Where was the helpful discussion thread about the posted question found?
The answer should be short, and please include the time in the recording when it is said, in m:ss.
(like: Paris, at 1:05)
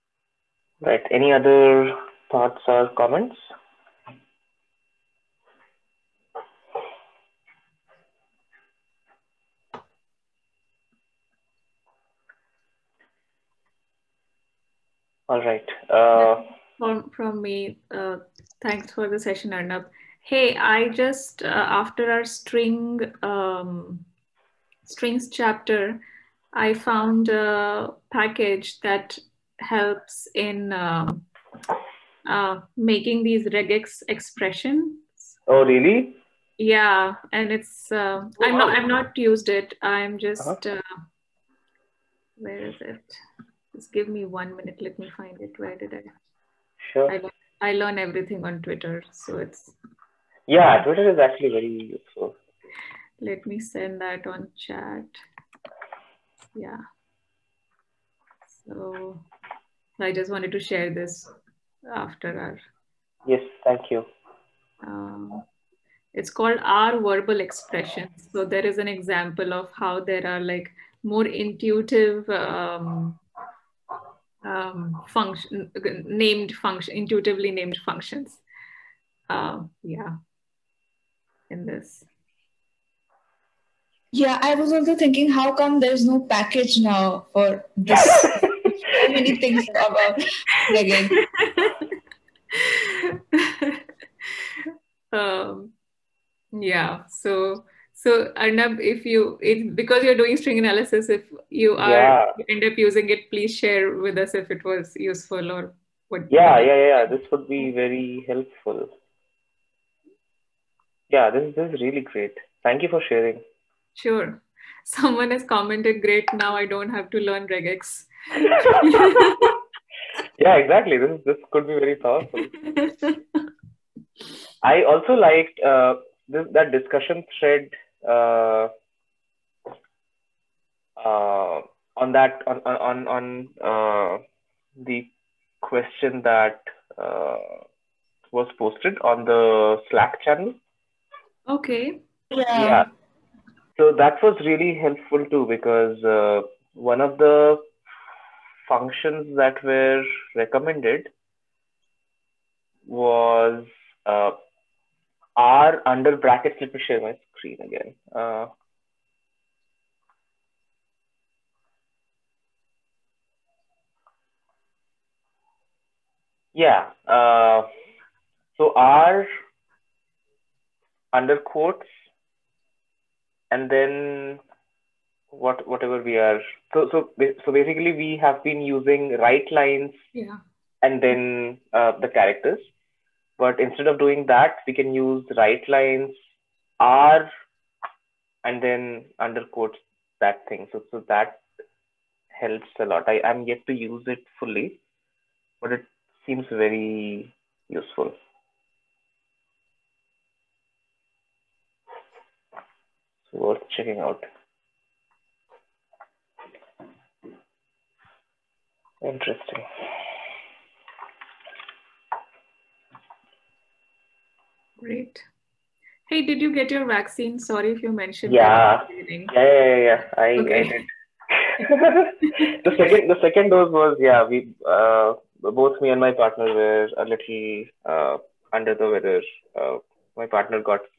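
Slack channel, at 2:19.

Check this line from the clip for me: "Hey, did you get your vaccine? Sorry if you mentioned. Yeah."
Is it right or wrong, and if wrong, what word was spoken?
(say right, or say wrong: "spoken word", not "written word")
right.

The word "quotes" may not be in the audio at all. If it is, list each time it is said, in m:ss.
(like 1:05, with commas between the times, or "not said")
2:51, 3:09.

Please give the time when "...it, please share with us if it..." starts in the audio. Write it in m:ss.
1:43.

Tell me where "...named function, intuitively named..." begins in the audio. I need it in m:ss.
1:16.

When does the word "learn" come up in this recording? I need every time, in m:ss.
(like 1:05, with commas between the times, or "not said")
0:47, 1:57.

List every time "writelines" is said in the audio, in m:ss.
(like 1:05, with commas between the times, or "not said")
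2:59, 3:05.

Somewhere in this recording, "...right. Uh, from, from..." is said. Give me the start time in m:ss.
0:15.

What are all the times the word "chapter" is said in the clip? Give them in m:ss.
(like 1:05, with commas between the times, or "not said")
0:25.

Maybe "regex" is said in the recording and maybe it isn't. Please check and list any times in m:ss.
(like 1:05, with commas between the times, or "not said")
0:33, 1:57.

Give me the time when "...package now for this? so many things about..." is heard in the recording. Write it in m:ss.
1:26.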